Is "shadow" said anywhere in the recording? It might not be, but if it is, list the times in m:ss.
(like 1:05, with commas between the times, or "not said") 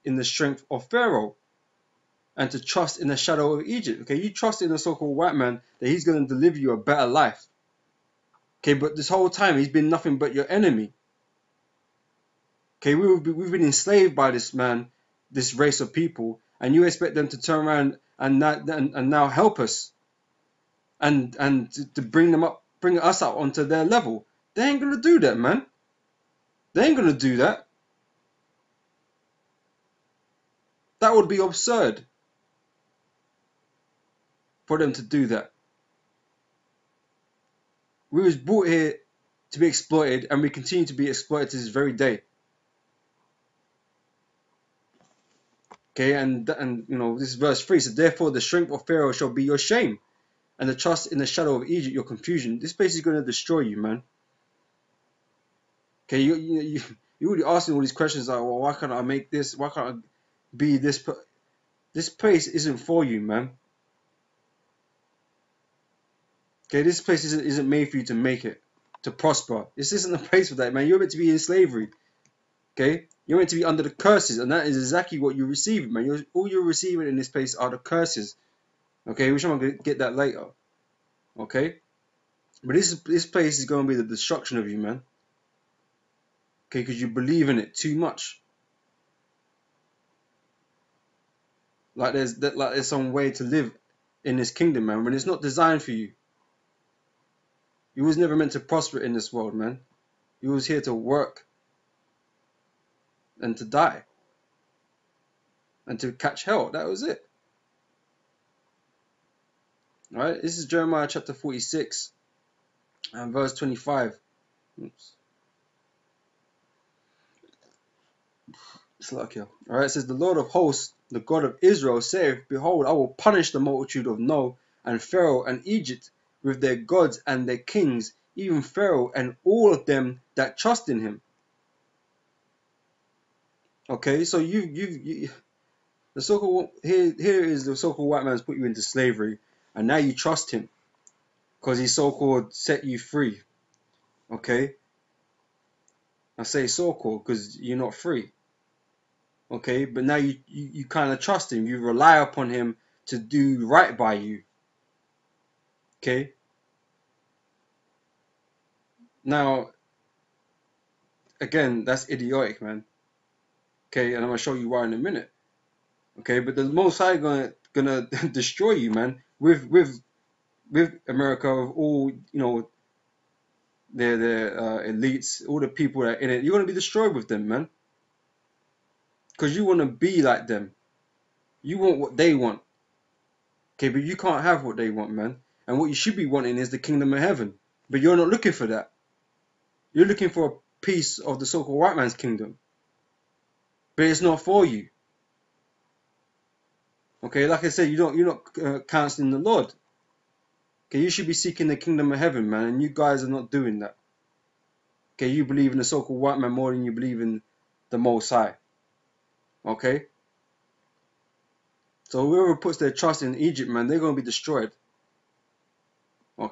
0:03, 0:51.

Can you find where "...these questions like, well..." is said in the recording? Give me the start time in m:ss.
0:57.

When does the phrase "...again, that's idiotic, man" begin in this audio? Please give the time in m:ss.
2:41.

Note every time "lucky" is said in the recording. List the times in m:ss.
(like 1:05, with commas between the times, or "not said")
1:59.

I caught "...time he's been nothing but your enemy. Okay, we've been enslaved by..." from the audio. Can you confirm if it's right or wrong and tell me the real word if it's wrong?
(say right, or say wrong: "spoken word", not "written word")
right.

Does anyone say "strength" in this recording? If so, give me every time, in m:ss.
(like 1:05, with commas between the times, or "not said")
0:00, 0:48.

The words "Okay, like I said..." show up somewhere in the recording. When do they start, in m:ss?
3:17.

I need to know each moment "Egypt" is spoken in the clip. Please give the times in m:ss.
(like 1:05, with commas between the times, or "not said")
0:03, 0:51, 2:05, 3:33.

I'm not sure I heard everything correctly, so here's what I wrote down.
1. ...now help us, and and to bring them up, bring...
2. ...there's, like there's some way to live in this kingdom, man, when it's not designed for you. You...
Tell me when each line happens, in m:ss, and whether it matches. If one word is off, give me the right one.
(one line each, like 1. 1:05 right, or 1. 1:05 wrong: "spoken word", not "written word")
1. 0:19 right
2. 1:32 right.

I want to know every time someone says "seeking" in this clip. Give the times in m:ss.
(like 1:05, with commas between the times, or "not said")
3:21.